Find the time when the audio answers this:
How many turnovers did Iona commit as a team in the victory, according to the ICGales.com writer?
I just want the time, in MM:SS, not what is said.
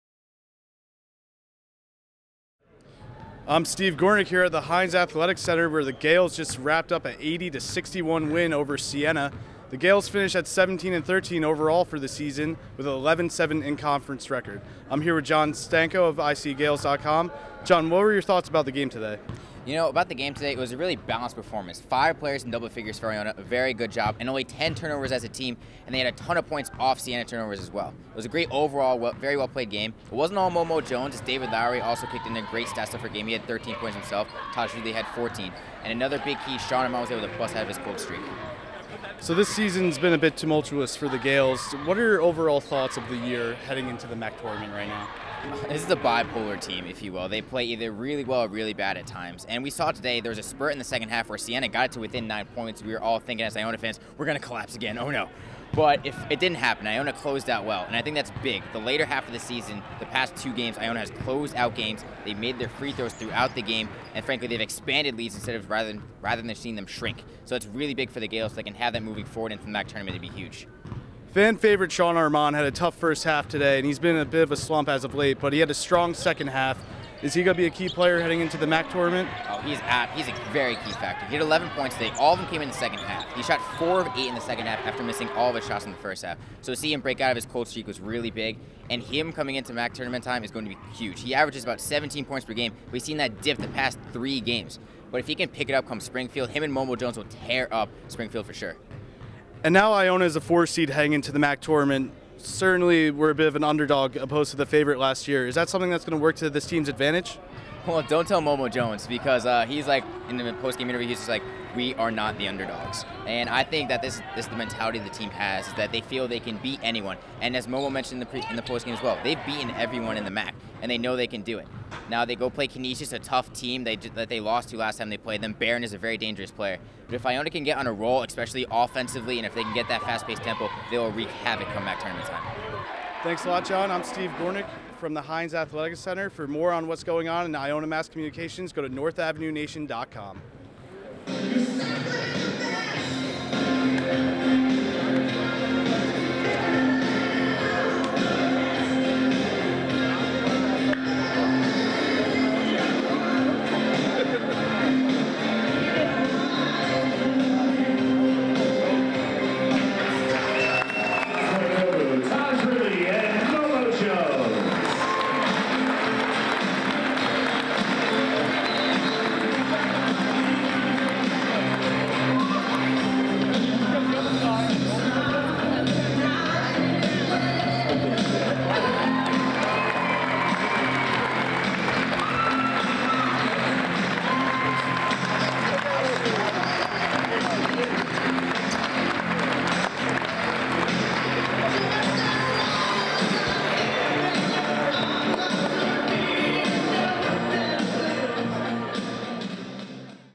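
00:24.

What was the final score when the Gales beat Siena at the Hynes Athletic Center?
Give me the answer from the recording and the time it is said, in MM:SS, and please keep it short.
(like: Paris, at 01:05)
80 to 61, at 00:07.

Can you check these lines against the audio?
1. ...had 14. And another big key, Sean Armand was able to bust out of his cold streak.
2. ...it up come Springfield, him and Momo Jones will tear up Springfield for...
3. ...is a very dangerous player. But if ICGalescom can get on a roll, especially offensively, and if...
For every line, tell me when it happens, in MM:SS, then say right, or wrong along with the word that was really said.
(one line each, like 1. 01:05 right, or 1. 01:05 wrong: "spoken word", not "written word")
1. 00:34 right
2. 01:35 right
3. 02:05 wrong: "Iona", not "ICGalescom".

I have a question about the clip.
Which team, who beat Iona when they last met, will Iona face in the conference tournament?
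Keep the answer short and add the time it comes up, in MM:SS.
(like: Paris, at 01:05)
Canisius, at 02:02.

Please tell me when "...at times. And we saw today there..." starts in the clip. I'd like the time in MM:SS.
00:48.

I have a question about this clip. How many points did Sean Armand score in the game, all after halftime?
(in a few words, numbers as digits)
11.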